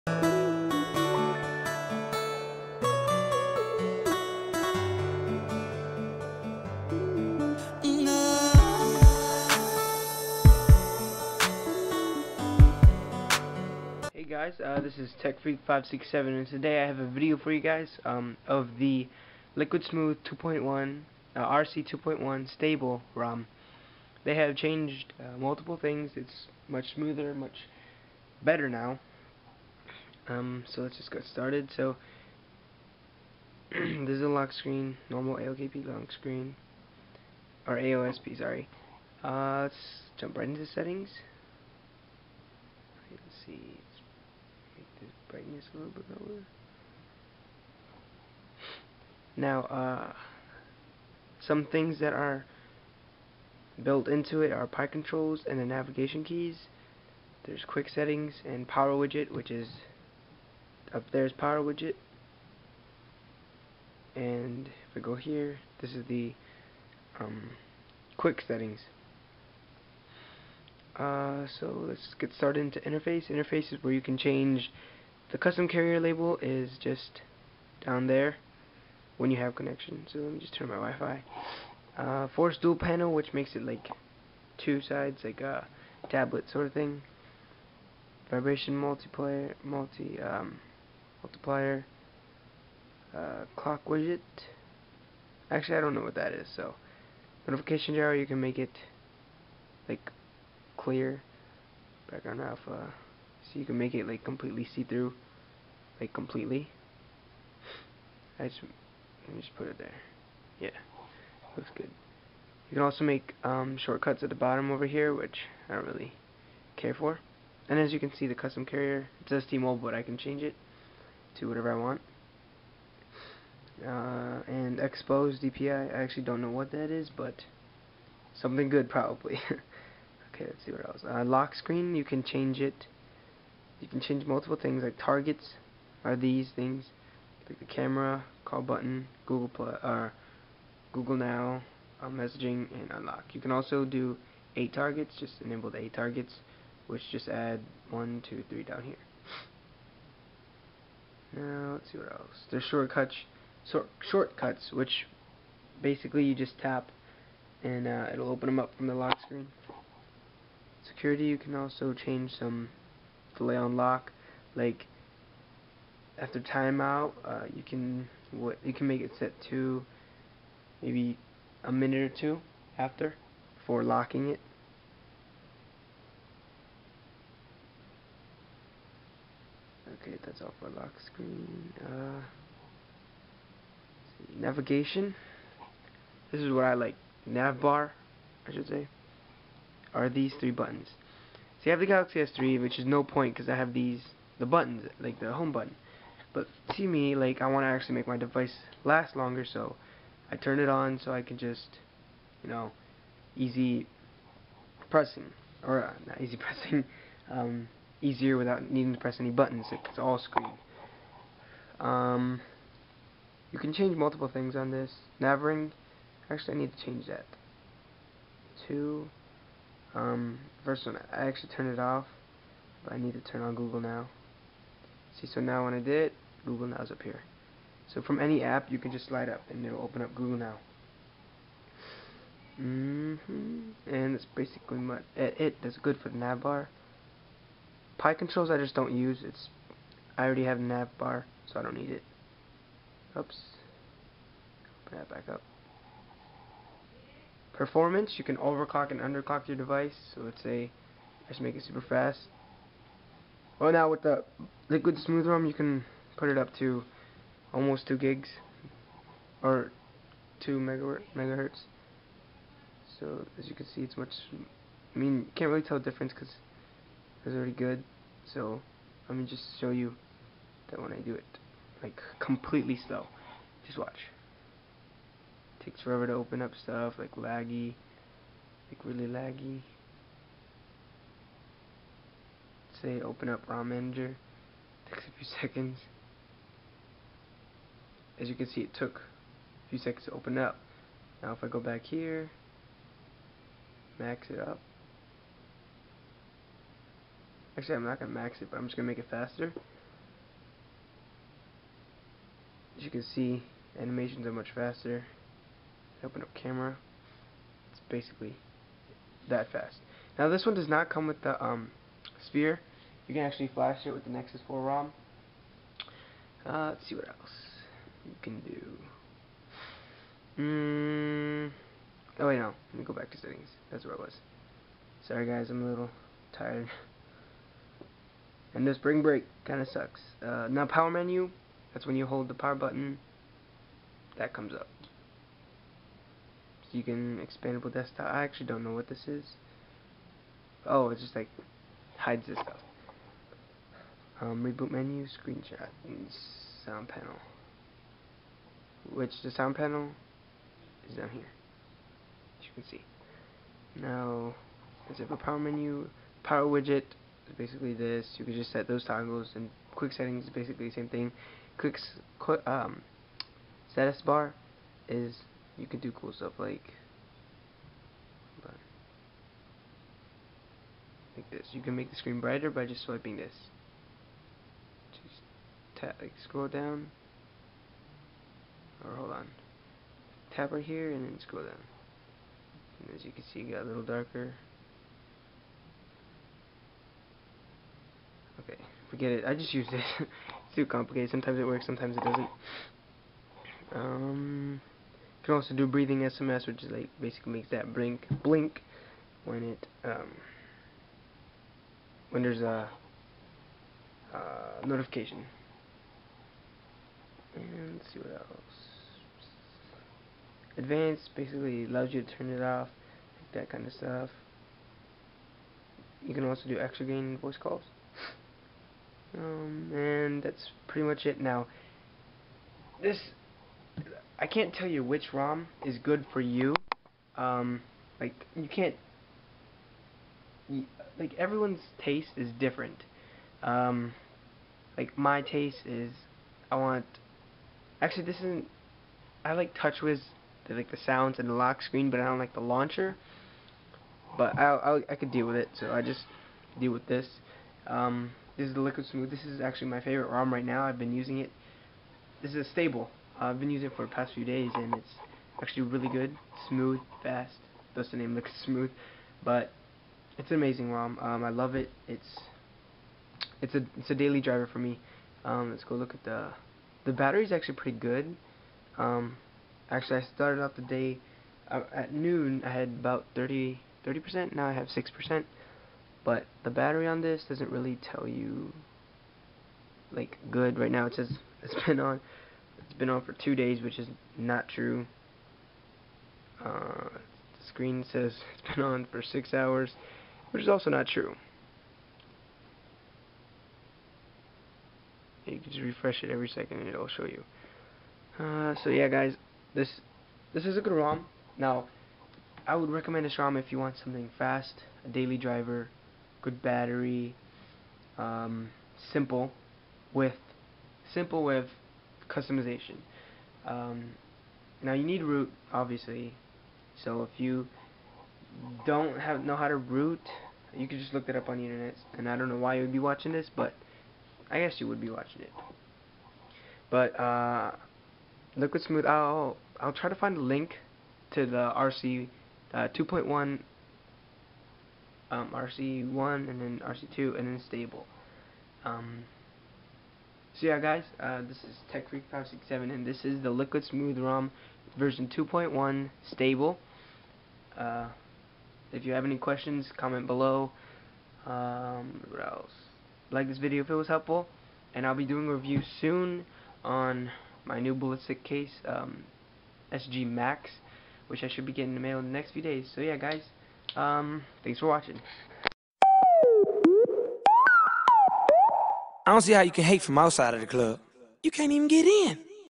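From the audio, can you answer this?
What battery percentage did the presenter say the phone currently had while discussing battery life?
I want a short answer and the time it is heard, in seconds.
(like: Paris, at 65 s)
6 percent, at 474 s.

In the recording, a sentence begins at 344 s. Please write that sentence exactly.
Um, reboot menu, screenshot, and sound panel.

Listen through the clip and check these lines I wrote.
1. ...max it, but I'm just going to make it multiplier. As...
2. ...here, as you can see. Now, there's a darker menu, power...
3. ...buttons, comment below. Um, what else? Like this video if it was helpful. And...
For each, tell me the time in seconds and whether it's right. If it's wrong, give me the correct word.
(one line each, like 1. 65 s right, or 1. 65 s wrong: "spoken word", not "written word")
1. 298 s wrong: "faster", not "multiplier"
2. 351 s wrong: "power", not "darker"
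3. 549 s wrong: "questions", not "buttons".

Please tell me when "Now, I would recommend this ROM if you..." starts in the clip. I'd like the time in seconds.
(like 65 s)
501 s.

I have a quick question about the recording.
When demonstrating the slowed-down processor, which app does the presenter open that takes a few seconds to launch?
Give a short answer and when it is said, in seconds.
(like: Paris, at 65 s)
ROM Manager, at 283 s.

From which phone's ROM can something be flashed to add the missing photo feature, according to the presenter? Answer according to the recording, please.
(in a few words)
Nexus 4.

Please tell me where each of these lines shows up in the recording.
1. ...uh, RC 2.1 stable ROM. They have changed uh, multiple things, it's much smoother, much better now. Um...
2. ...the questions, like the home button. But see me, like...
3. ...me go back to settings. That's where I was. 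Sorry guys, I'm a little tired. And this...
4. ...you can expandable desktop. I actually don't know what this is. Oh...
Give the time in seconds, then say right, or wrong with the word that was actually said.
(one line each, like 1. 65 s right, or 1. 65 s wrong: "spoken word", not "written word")
1. 21 s right
2. 194 s wrong: "buttons", not "questions"
3. 322 s right
4. 336 s right.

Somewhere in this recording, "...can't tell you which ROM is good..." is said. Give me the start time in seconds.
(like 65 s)
424 s.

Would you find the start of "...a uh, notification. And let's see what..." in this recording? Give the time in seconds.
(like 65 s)
402 s.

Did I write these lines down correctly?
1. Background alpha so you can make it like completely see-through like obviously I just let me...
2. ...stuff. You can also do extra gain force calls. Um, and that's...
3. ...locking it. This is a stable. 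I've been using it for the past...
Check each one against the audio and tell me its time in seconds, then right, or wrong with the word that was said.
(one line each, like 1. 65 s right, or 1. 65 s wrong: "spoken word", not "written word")
1. 102 s wrong: "completely", not "obviously"
2. 413 s wrong: "voice", not "force"
3. 450 s wrong: "using", not "locking".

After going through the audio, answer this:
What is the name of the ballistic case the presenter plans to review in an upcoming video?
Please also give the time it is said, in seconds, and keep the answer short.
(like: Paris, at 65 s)
SG Maxx, at 559 s.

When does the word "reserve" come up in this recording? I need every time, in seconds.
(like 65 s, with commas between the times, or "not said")
not said.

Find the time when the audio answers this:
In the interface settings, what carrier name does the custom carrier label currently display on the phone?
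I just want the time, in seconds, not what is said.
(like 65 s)
119 s.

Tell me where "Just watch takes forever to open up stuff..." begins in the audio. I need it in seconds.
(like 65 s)
273 s.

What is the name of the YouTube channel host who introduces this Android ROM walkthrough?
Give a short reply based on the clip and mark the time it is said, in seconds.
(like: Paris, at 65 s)
TechFreak567, at 15 s.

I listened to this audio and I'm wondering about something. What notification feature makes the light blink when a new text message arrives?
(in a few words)
Breathing SMS.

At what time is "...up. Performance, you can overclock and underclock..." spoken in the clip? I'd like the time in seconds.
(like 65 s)
245 s.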